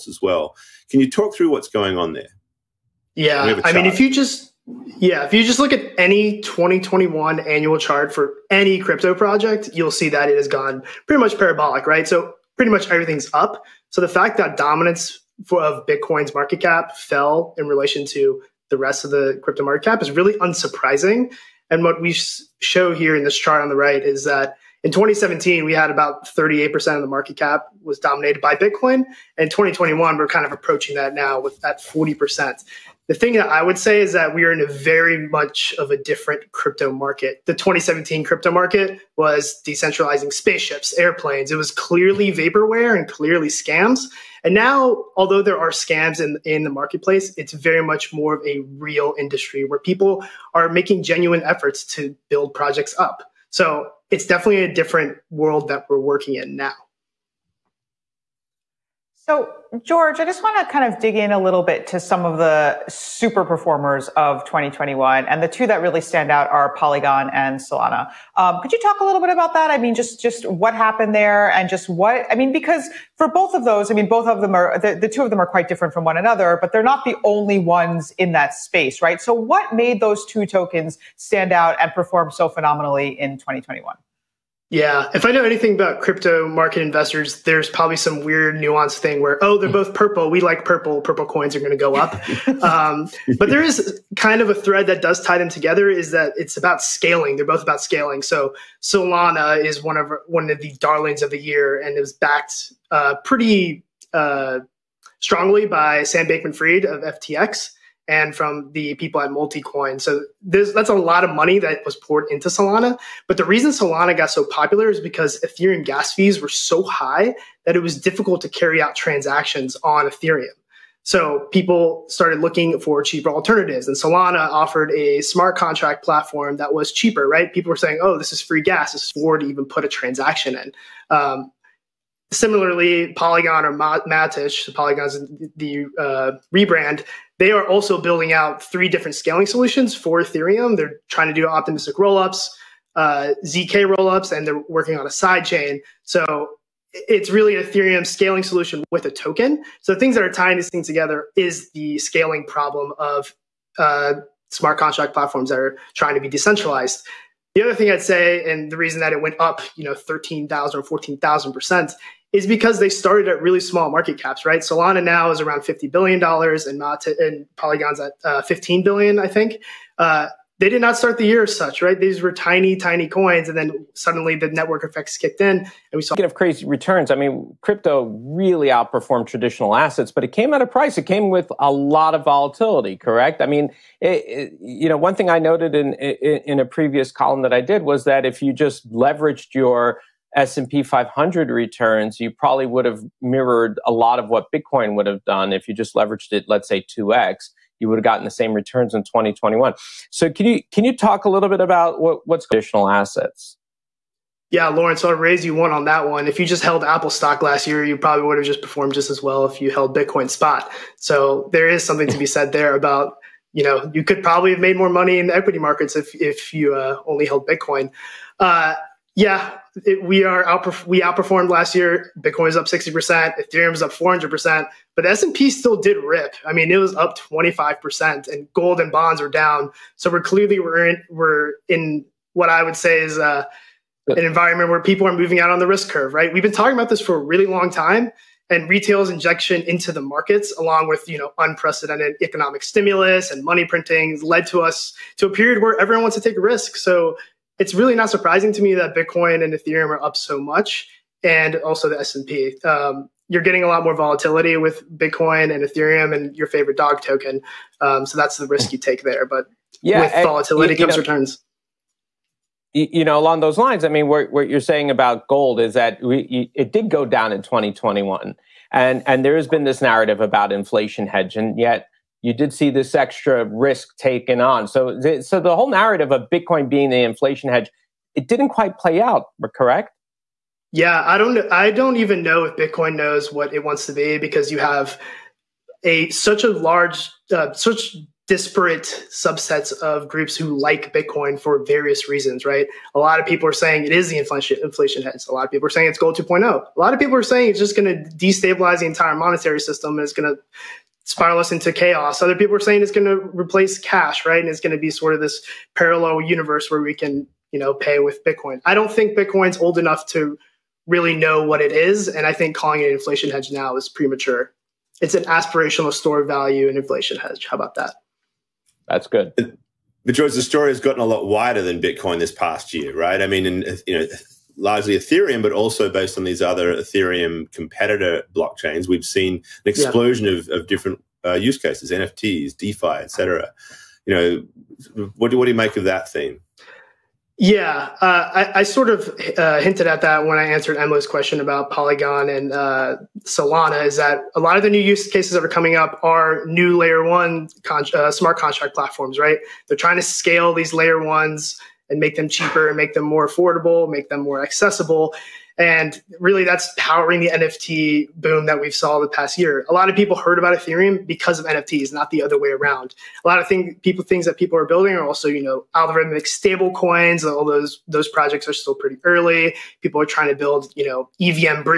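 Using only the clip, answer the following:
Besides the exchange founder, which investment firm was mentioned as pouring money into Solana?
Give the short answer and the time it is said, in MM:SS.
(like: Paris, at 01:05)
Multicoin, at 01:49.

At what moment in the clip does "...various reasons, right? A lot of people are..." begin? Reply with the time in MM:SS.
04:51.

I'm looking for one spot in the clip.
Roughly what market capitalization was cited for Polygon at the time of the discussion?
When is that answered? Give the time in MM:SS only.
02:48.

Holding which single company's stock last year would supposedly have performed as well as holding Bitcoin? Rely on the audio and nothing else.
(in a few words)
Apple.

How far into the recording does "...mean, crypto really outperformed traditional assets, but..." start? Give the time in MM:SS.
02:57.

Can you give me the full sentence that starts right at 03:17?
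You would have gotten the same returns in 2021.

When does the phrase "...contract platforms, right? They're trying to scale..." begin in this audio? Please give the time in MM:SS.
05:48.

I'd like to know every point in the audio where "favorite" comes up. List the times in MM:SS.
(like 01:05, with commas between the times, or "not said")
04:16.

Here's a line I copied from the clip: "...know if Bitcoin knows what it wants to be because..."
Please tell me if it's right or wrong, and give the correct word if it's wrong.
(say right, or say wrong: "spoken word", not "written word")
right.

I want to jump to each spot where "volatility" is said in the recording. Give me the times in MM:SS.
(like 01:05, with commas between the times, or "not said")
03:02, 04:13, 04:20.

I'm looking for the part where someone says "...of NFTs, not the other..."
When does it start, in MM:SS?
06:01.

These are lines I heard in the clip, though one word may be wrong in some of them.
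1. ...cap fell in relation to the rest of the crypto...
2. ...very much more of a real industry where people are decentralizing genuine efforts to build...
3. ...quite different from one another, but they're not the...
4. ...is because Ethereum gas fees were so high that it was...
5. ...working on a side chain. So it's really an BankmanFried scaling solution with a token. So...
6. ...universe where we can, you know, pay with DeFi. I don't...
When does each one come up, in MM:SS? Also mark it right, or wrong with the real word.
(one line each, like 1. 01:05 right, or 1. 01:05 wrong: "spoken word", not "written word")
1. 00:16 right
2. 00:47 wrong: "making", not "decentralizing"
3. 01:15 right
4. 01:54 right
5. 02:24 wrong: "Ethereum", not "BankmanFried"
6. 05:06 wrong: "Bitcoin", not "DeFi".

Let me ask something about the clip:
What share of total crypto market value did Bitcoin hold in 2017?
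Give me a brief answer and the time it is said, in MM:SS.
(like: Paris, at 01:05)
38%, at 00:26.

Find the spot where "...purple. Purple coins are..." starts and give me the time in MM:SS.
01:30.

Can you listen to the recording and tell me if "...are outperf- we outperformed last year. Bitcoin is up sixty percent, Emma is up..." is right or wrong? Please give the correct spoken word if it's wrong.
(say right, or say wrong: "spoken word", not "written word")
wrong: "Ethereum", not "Emma".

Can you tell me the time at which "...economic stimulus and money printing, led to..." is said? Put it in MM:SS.
04:02.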